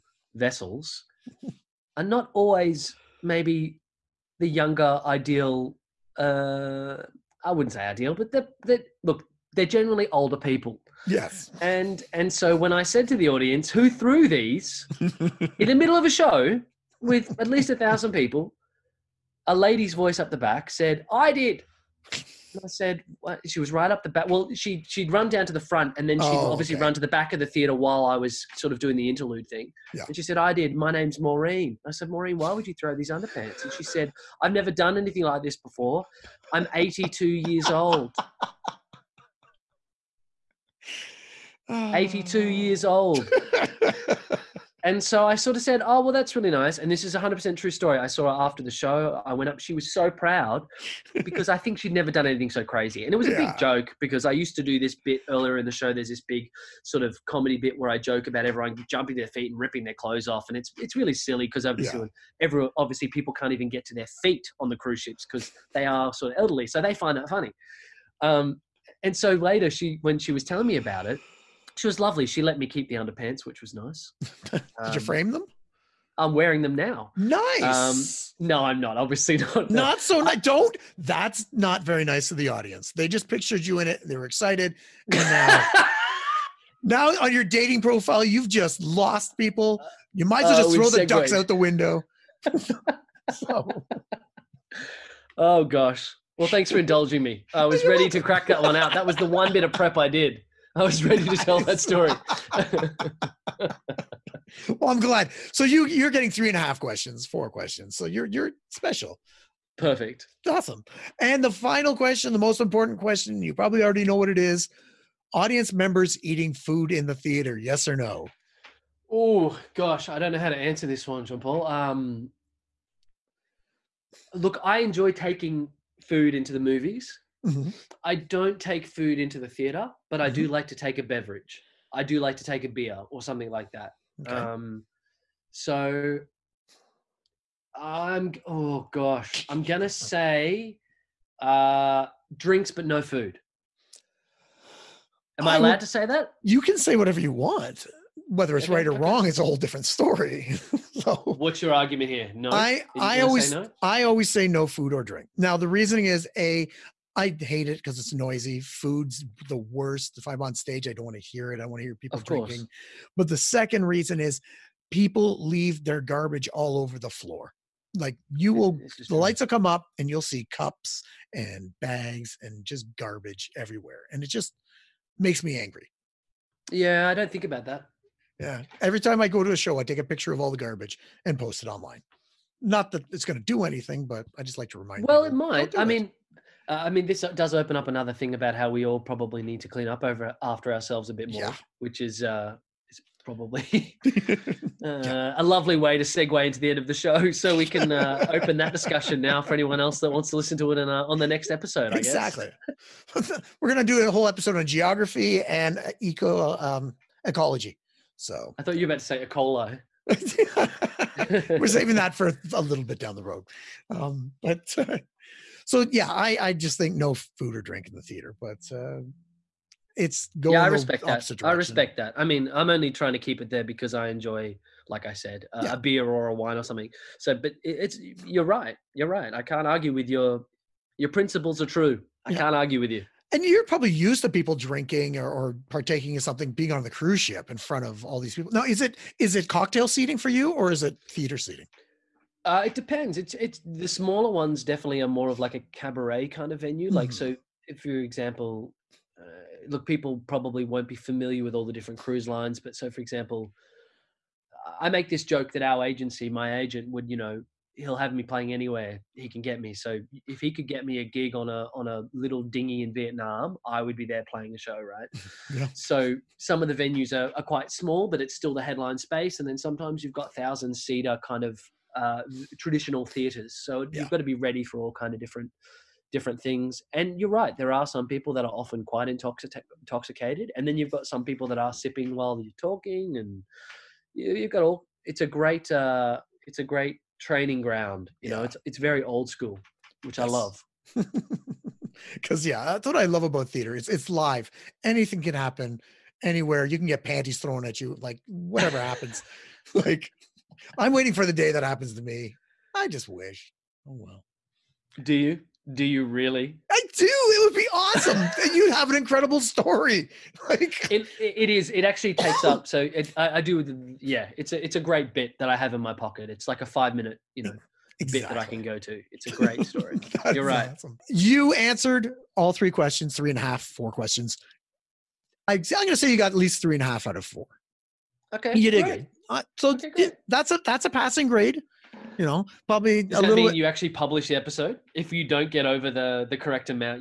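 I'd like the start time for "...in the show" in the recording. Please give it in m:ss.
0:55.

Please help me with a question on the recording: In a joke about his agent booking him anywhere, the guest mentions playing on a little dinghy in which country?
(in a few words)
Vietnam.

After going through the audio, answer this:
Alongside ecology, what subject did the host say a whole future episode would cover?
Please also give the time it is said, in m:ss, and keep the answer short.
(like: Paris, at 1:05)
Geography, at 3:24.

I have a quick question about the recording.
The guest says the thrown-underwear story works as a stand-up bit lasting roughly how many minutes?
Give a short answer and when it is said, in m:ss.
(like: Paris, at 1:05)
5 minutes, at 5:16.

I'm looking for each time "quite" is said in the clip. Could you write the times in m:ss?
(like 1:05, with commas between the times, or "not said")
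4:27, 4:38.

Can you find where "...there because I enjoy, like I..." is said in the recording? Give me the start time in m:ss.
3:43.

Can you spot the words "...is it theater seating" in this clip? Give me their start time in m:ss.
4:00.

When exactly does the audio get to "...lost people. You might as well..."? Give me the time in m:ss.
1:28.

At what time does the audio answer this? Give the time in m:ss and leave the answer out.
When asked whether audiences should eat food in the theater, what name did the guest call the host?
2:01.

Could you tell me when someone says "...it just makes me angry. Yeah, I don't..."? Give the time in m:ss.
2:54.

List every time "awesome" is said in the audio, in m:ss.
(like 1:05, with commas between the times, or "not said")
1:50, 5:07, 5:20.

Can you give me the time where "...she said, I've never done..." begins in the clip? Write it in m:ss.
0:33.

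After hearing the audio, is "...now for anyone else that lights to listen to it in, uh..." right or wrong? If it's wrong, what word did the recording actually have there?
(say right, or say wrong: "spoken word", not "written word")
wrong: "wants", not "lights".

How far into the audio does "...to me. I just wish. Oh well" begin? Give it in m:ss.
5:01.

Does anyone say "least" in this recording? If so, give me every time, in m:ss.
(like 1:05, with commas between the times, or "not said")
0:17, 5:26.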